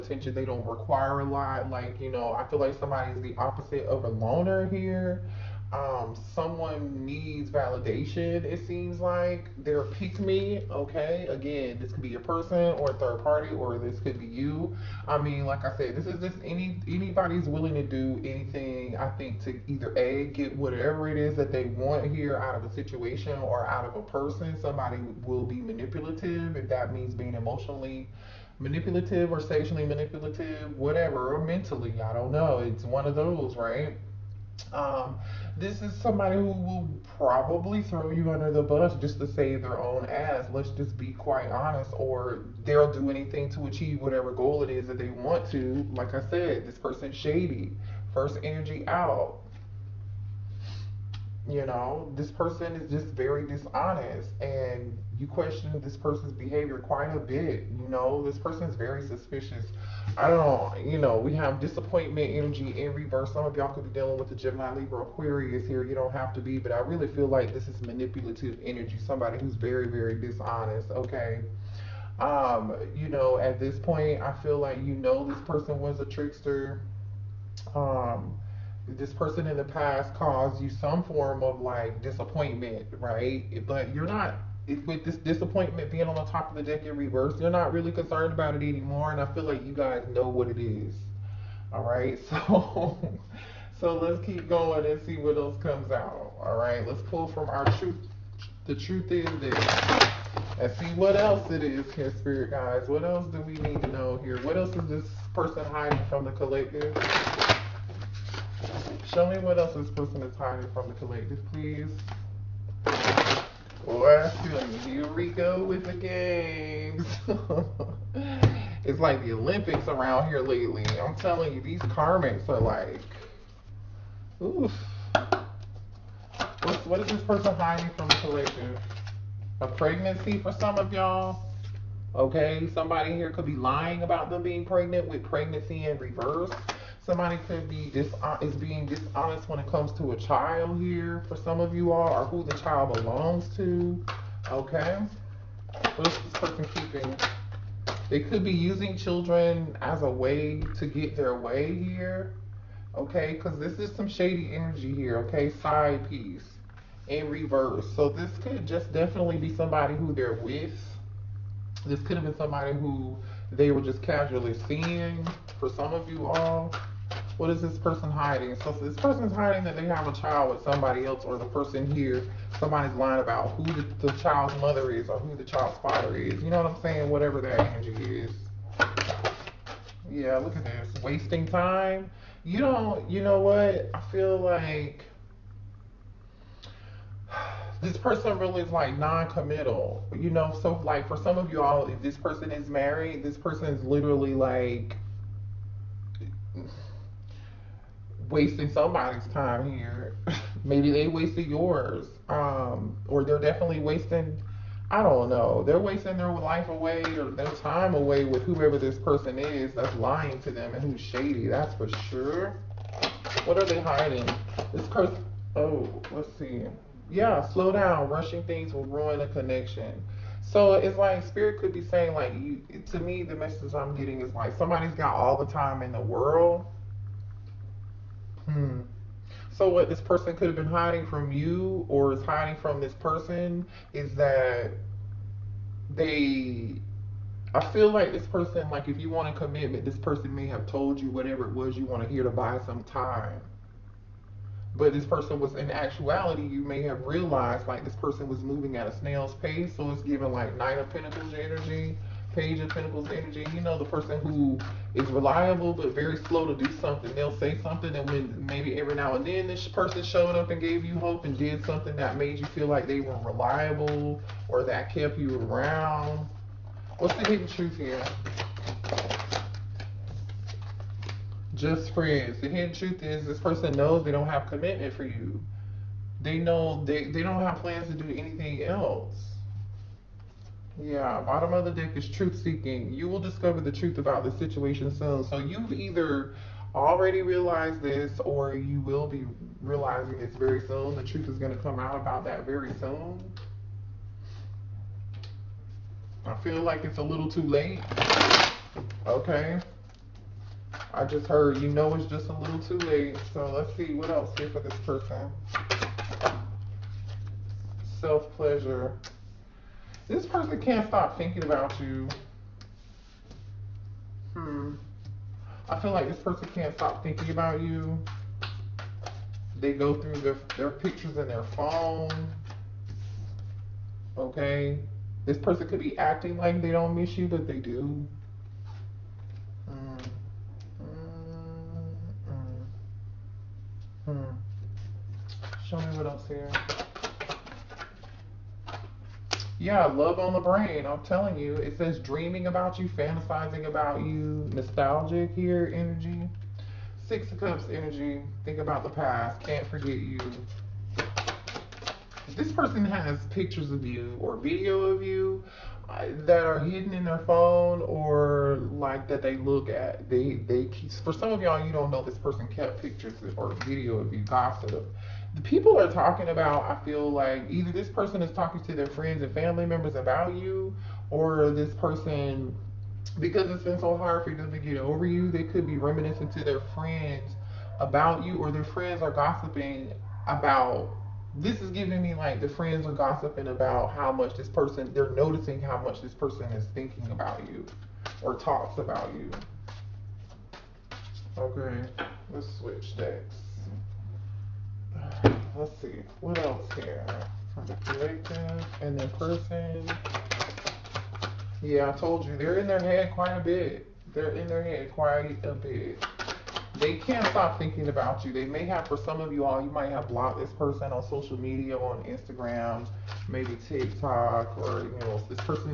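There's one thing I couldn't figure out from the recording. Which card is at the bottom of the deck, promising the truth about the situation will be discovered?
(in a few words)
Truth seeking.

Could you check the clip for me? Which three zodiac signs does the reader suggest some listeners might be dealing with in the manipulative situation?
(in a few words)
Gemini, Libra, Aquarius.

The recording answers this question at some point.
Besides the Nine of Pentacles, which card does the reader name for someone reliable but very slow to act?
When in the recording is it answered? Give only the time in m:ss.
4:12.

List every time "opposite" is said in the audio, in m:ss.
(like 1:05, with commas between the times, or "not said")
0:03.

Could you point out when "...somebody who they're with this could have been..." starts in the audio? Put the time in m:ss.
2:39.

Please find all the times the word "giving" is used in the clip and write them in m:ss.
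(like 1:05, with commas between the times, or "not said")
4:10, 6:21.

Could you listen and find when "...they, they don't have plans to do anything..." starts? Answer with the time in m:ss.
4:36.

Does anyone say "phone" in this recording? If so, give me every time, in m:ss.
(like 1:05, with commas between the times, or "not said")
5:21, 5:57.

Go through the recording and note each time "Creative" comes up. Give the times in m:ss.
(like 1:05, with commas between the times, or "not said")
6:37.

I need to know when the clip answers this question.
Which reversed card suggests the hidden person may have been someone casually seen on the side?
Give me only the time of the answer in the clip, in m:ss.
2:35.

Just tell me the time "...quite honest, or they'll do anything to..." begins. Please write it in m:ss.
0:41.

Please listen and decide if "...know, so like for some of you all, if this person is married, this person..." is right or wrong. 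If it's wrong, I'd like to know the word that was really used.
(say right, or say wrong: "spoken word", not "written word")
right.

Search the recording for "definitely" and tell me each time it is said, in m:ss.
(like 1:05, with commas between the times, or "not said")
2:38, 3:23.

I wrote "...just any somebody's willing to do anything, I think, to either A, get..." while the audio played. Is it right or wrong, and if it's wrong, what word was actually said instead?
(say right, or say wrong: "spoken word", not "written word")
wrong: "anybody", not "somebody".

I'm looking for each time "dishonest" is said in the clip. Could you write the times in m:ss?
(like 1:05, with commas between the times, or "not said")
0:53, 1:10, 2:18.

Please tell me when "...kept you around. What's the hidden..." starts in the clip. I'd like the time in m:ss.
4:24.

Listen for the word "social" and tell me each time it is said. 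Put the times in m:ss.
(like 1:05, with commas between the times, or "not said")
6:51.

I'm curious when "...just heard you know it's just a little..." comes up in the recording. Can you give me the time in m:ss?
5:01.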